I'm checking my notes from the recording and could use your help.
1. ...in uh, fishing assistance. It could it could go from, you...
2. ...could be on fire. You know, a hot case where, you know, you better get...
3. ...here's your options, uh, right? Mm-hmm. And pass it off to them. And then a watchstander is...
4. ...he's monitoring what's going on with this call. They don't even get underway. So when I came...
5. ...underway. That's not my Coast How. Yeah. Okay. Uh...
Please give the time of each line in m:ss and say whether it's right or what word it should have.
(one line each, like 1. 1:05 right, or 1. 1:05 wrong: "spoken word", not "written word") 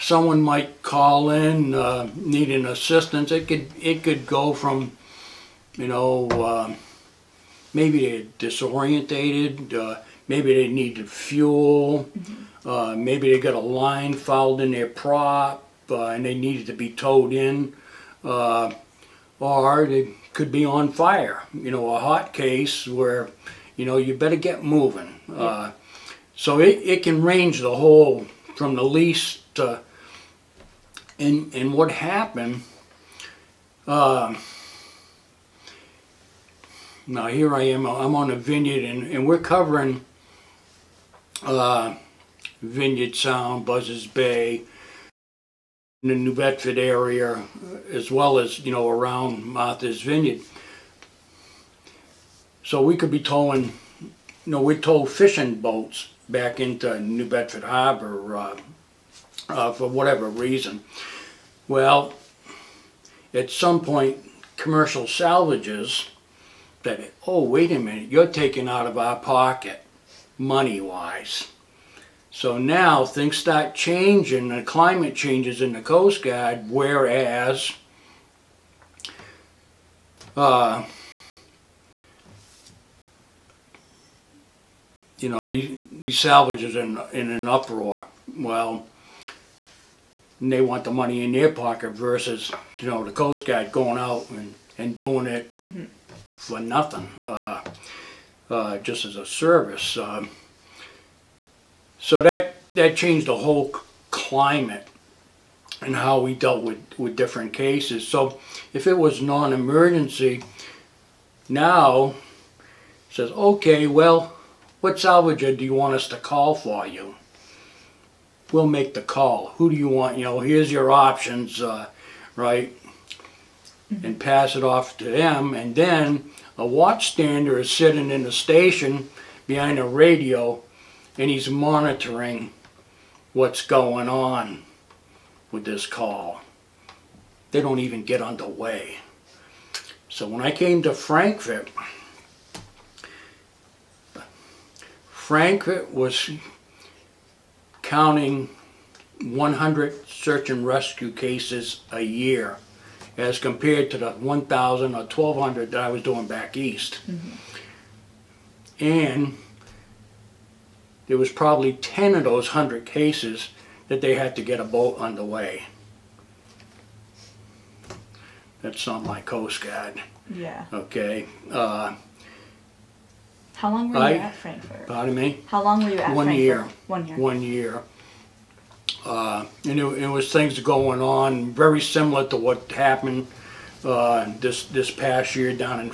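1. 0:01 wrong: "needing", not "fishing"
2. 0:20 right
3. 2:00 right
4. 2:11 right
5. 2:44 wrong: "Guard", not "How".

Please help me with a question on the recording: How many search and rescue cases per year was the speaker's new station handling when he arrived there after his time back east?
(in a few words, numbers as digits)
100.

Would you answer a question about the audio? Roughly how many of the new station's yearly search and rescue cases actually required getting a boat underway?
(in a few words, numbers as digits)
10.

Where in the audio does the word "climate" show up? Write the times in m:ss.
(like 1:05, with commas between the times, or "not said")
1:14, 1:44.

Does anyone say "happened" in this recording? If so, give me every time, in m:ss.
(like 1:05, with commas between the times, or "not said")
0:31, 3:02.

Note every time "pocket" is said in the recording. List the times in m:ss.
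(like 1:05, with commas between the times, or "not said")
1:09, 1:31.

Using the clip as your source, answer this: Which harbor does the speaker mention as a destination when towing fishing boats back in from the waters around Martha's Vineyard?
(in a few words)
New Bedford Harbor.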